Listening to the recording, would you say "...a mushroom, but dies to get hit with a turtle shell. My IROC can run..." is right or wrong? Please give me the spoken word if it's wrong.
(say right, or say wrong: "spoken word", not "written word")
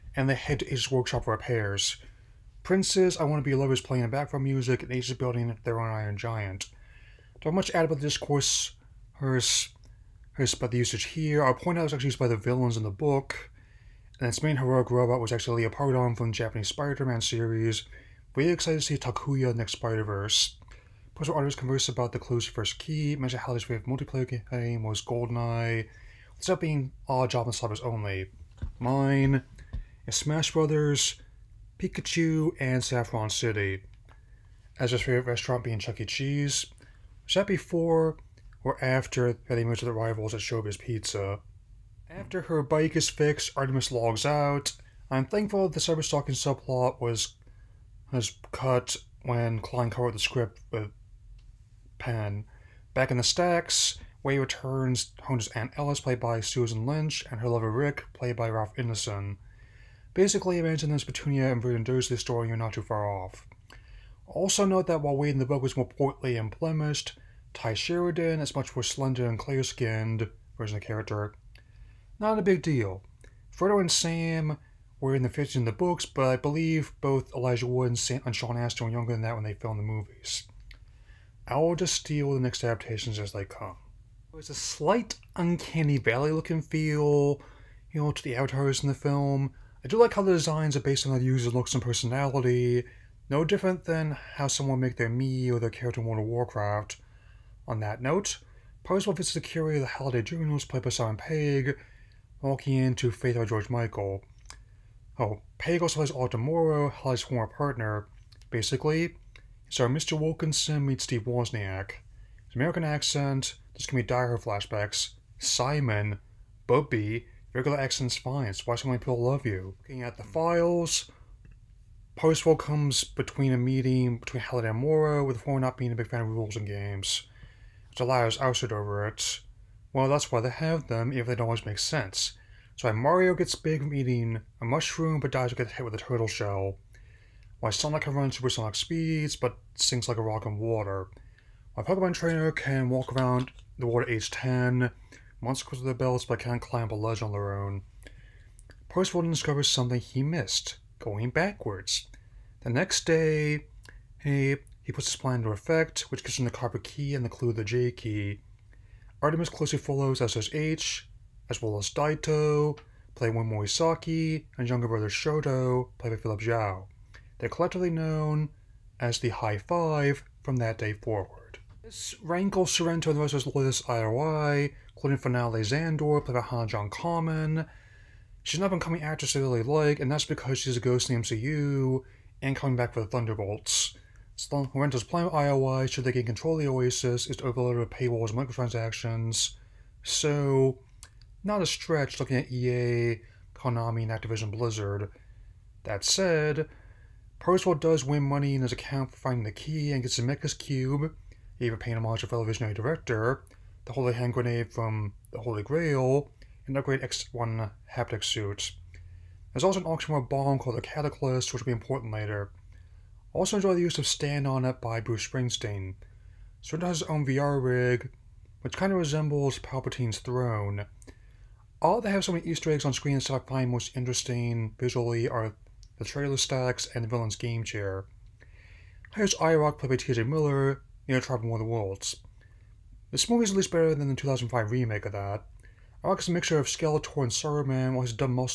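wrong: "Sonic", not "IROC".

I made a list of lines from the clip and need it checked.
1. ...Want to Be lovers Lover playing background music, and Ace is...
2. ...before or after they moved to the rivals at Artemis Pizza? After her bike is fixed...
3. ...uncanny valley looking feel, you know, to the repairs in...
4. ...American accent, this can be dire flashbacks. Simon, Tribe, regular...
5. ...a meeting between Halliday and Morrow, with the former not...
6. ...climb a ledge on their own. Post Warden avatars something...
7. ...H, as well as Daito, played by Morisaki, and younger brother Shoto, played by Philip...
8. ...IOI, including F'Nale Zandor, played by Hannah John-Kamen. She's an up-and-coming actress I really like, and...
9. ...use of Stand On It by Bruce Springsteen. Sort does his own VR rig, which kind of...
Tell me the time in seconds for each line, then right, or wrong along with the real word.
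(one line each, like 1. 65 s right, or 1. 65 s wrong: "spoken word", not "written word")
1. 3 s right
2. 37 s wrong: "Showbiz", not "Artemis"
3. 85 s wrong: "avatars", not "repairs"
4. 112 s wrong: "Bubby", not "Tribe"
5. 123 s right
6. 146 s wrong: "discovers", not "avatars"
7. 160 s right
8. 173 s right
9. 213 s right.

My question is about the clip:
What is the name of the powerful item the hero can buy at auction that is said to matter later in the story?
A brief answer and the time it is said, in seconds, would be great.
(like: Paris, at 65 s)
the Cataclysm, at 210 s.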